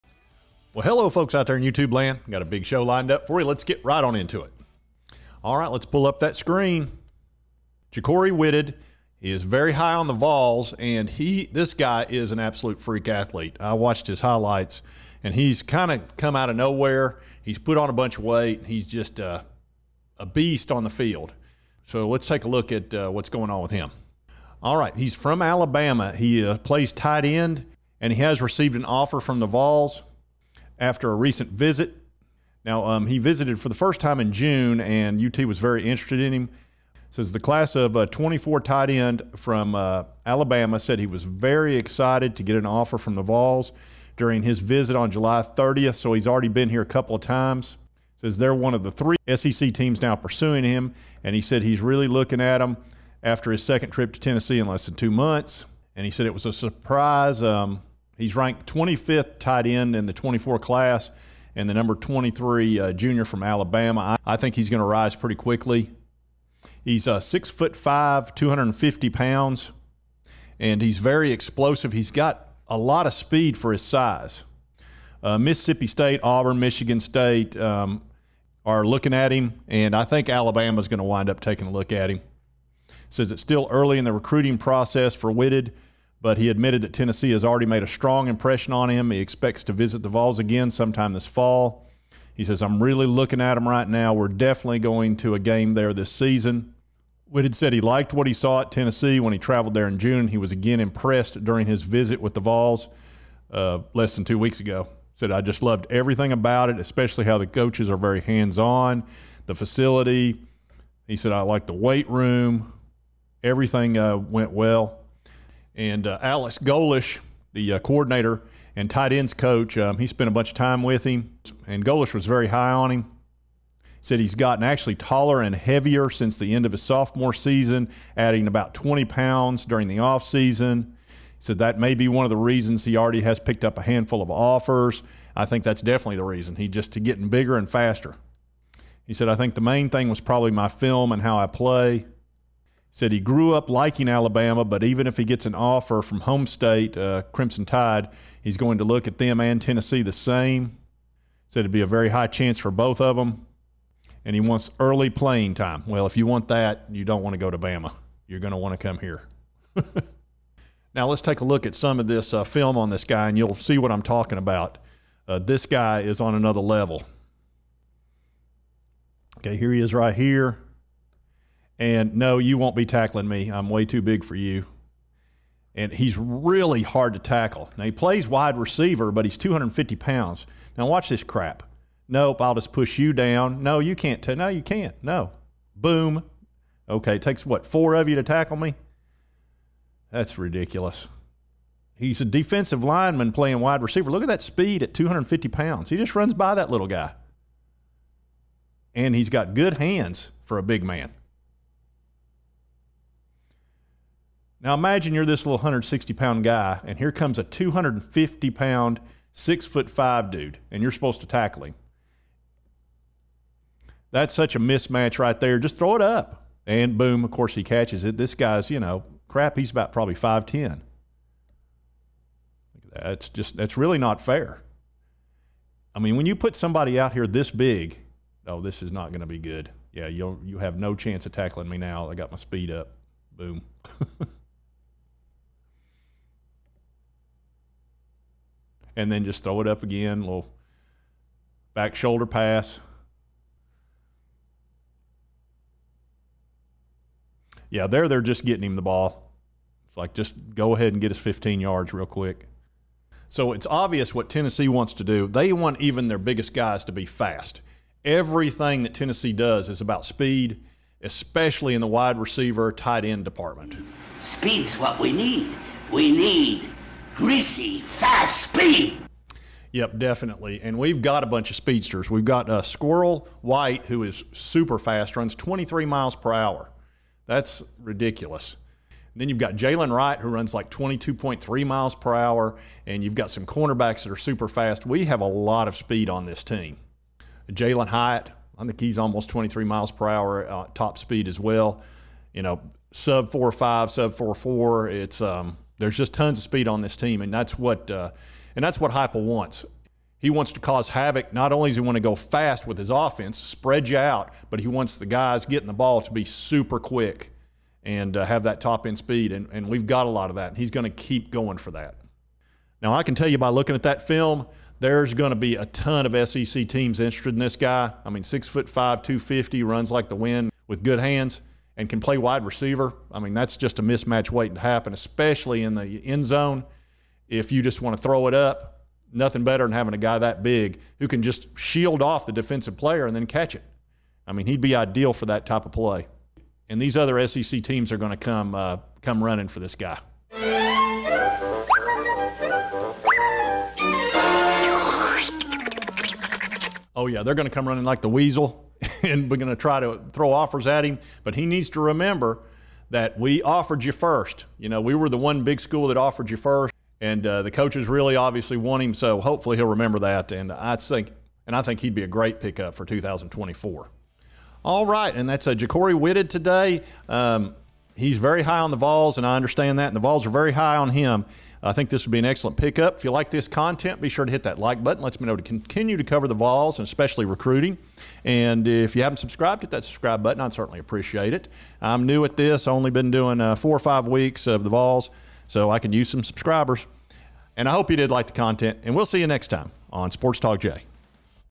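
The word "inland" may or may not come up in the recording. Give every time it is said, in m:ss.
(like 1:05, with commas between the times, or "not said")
not said.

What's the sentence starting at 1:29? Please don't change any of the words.
He expects to visit the Vols again sometime this fall.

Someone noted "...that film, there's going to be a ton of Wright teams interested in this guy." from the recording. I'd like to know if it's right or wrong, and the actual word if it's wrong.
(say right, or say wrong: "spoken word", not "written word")
wrong: "SEC", not "Wright".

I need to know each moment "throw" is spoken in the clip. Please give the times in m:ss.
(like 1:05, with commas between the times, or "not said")
3:35, 3:59, 5:28, 5:50.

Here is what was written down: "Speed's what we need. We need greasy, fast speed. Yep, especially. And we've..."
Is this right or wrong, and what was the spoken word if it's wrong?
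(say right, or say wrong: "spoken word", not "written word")
wrong: "definitely", not "especially".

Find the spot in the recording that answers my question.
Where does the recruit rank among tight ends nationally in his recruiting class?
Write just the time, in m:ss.
0:58.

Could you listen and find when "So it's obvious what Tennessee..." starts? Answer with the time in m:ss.
4:13.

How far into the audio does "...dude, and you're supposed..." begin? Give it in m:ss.
3:30.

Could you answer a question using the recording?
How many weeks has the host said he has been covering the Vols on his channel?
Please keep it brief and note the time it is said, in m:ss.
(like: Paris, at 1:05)
4 or 5 weeks, at 6:23.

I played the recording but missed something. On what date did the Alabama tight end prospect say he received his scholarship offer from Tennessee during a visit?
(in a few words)
July 30th.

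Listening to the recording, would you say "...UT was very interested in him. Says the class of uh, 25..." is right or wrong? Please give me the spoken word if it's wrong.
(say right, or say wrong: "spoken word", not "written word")
wrong: "24", not "25".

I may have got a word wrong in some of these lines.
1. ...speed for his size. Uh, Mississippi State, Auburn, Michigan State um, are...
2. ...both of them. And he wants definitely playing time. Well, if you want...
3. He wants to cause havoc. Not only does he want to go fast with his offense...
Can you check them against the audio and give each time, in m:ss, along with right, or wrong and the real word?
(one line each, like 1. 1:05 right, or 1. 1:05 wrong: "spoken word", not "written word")
1. 1:13 right
2. 2:32 wrong: "early", not "definitely"
3. 5:00 right.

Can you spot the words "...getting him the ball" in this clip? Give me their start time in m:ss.
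4:08.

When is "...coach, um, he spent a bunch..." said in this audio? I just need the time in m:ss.
1:59.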